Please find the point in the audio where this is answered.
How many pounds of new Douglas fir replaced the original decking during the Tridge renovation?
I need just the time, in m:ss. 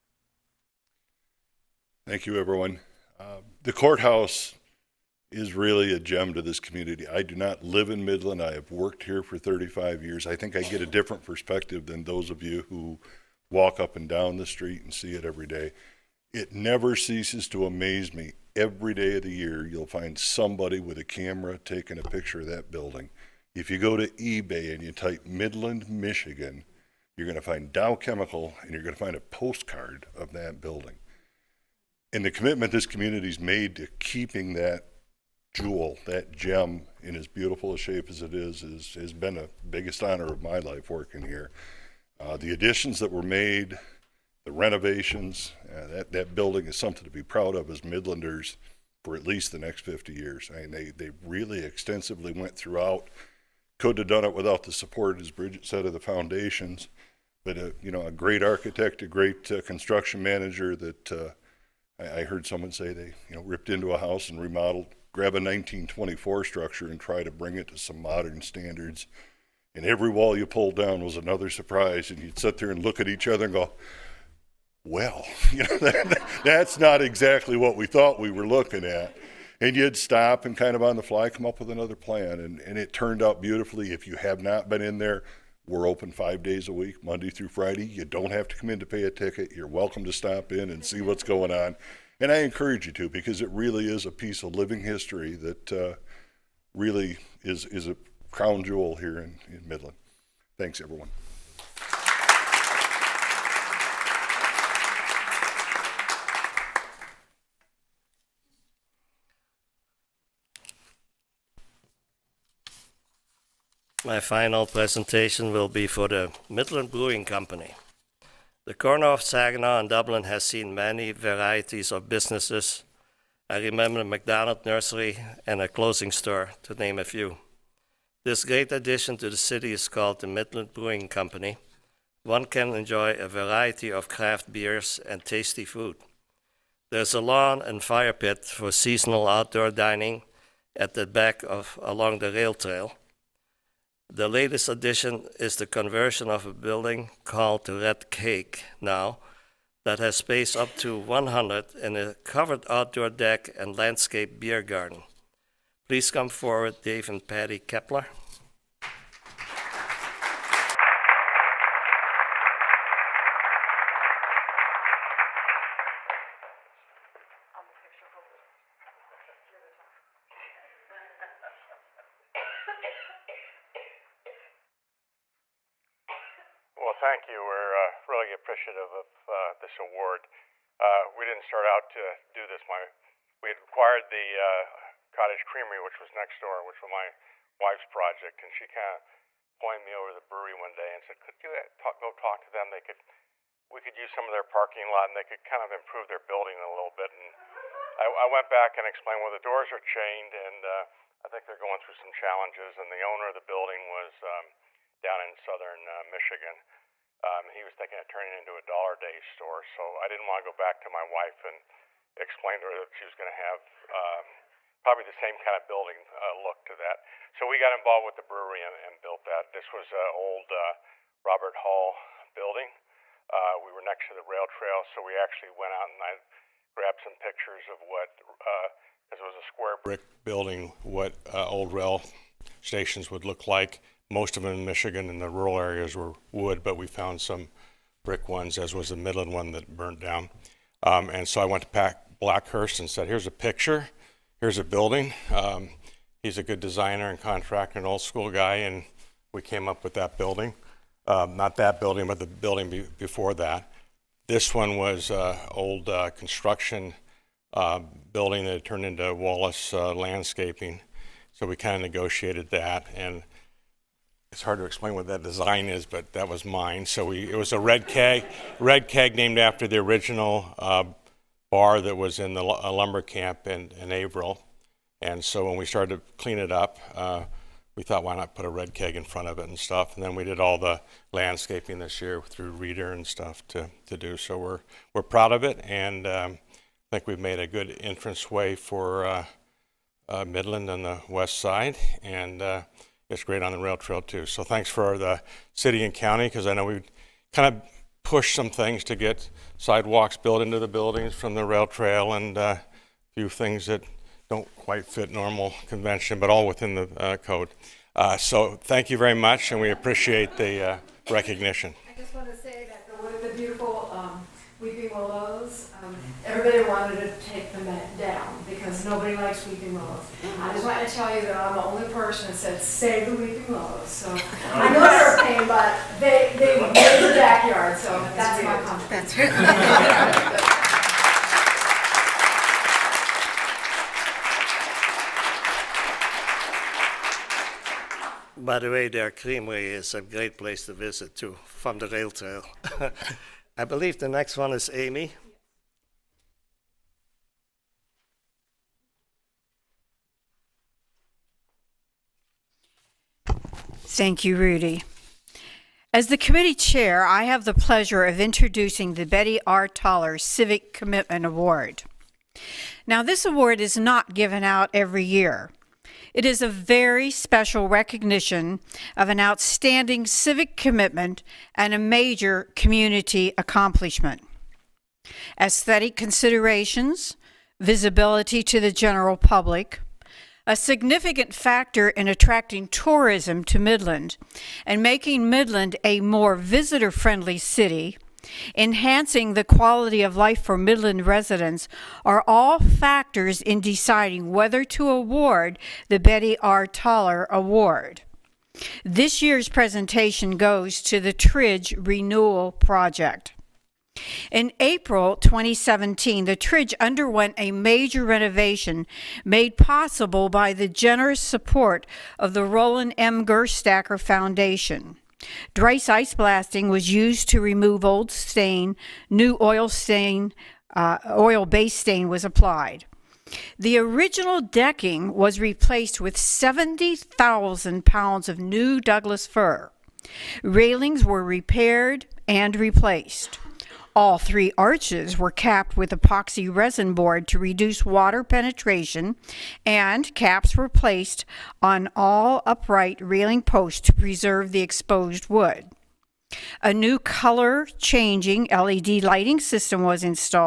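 7:06.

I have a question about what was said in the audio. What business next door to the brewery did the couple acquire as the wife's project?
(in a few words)
Cottage Creamery.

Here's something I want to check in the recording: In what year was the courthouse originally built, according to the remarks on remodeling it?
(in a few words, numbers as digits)
1924.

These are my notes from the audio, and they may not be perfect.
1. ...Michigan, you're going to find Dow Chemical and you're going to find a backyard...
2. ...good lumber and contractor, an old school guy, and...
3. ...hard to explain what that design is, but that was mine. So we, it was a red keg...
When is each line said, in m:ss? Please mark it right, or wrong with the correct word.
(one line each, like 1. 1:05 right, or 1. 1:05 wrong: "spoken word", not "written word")
1. 0:25 wrong: "postcard", not "backyard"
2. 4:06 wrong: "designer", not "lumber"
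3. 4:24 right.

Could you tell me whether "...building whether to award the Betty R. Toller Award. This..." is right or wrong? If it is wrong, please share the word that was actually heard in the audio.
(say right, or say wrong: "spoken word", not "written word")
wrong: "deciding", not "building".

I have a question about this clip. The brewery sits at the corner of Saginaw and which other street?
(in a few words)
Dublin.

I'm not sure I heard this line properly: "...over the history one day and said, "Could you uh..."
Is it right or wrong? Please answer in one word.
wrong.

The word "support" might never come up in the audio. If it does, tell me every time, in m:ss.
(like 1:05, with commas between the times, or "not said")
0:54, 6:51.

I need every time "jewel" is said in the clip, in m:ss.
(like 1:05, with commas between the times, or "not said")
0:35, 1:38.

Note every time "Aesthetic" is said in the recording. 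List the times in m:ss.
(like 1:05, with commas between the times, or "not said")
6:15.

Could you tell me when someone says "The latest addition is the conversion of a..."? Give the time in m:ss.
2:24.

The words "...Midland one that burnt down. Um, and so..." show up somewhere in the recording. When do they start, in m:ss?
3:58.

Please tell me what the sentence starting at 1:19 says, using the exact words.
And you'd stop and kind of on the fly come up with another plan.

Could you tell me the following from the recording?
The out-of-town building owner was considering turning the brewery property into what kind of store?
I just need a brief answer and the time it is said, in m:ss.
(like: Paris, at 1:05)
Dollar Day store, at 3:28.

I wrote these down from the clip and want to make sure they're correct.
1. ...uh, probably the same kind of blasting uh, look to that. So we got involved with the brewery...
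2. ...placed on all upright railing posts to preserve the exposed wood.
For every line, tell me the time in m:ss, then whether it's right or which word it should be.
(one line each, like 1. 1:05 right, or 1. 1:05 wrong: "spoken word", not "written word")
1. 3:33 wrong: "building", not "blasting"
2. 7:20 right.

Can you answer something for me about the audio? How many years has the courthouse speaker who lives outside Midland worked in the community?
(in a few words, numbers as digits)
35.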